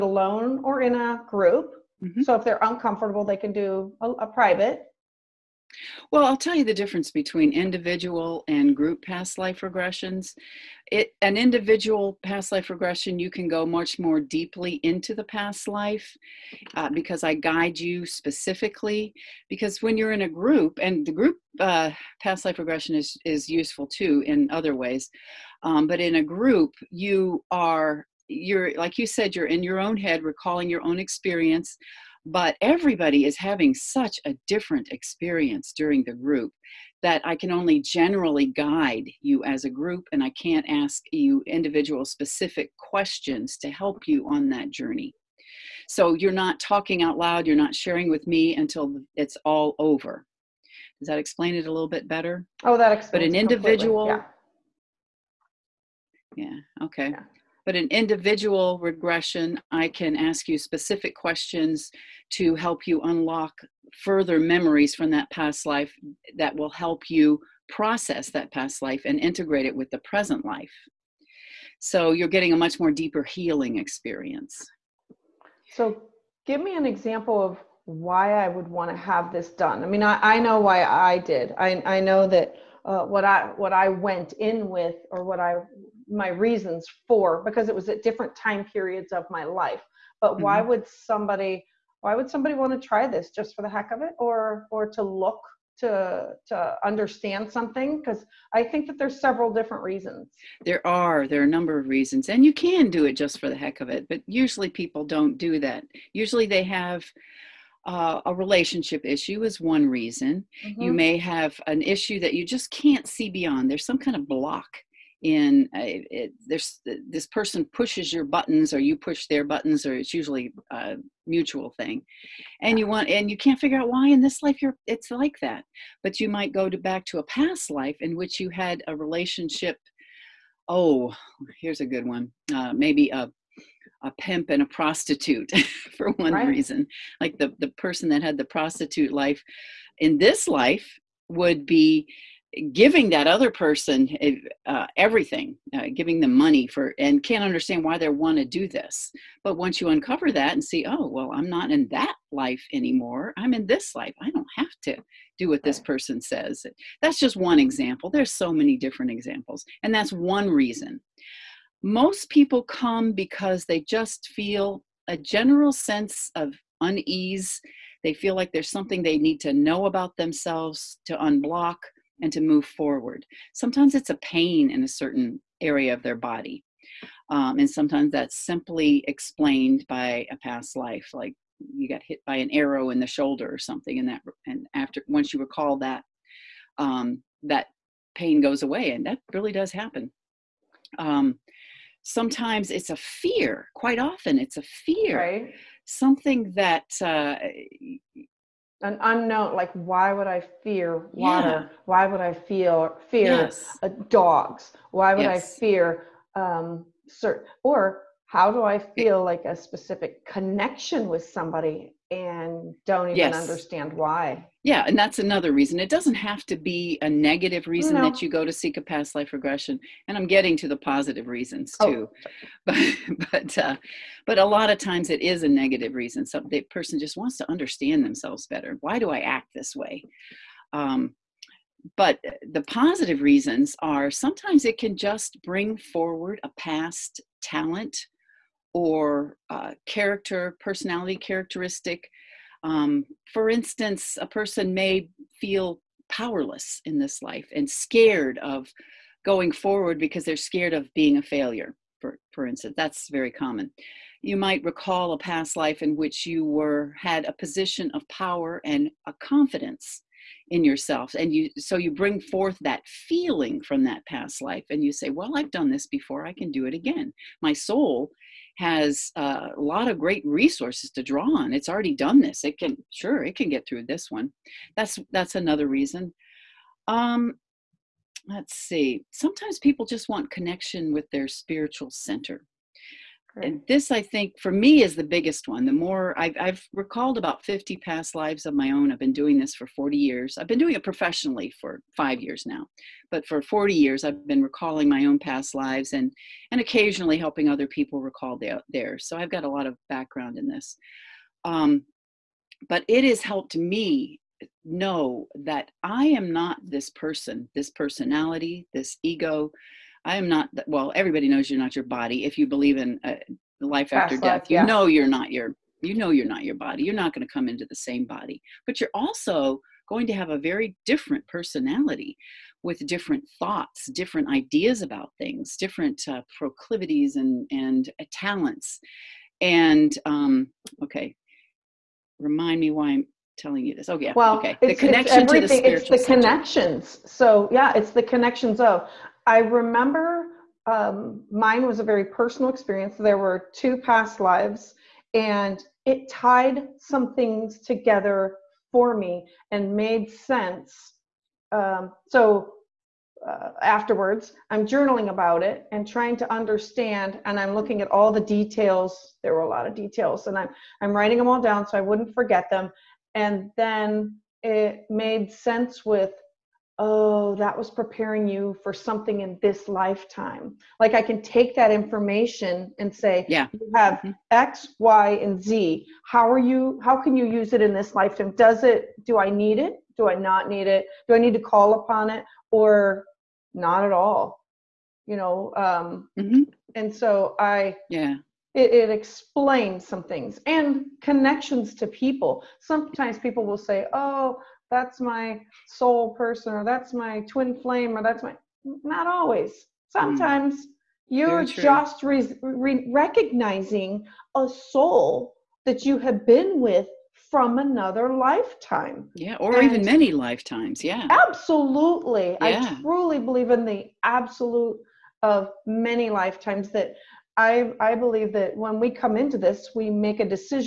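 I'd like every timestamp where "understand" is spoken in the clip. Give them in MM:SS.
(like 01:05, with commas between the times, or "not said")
01:36, 02:27, 03:33, 03:47, 05:56.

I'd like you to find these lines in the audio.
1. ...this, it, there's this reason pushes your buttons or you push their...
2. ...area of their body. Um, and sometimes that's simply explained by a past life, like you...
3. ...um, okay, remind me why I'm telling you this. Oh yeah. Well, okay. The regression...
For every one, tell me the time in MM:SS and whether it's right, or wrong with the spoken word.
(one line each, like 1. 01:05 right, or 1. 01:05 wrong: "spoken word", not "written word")
1. 01:55 wrong: "person", not "reason"
2. 02:55 right
3. 05:30 wrong: "connection", not "regression".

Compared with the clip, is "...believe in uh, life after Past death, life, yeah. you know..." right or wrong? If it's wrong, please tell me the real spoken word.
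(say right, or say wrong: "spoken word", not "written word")
right.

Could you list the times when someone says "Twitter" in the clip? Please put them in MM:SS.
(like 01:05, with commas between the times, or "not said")
not said.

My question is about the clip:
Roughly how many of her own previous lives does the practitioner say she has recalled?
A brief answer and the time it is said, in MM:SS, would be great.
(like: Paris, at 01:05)
50, at 04:47.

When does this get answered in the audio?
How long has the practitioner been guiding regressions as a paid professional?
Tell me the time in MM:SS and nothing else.
04:51.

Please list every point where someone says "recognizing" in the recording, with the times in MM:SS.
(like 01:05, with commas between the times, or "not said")
06:42.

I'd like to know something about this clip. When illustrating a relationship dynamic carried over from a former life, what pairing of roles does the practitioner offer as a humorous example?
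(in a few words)
a pimp and a prostitute.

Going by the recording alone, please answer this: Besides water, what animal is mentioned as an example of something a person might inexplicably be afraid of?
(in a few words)
dogs.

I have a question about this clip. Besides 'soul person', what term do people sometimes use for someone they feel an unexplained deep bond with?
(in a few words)
twin flame.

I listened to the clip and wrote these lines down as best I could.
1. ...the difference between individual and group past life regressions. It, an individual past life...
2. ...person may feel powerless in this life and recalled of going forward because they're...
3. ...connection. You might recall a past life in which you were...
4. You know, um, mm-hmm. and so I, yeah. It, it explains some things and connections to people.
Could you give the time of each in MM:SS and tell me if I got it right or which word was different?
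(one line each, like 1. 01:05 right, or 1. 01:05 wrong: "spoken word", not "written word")
1. 00:06 right
2. 04:04 wrong: "scared", not "recalled"
3. 04:13 wrong: "common", not "connection"
4. 06:25 right.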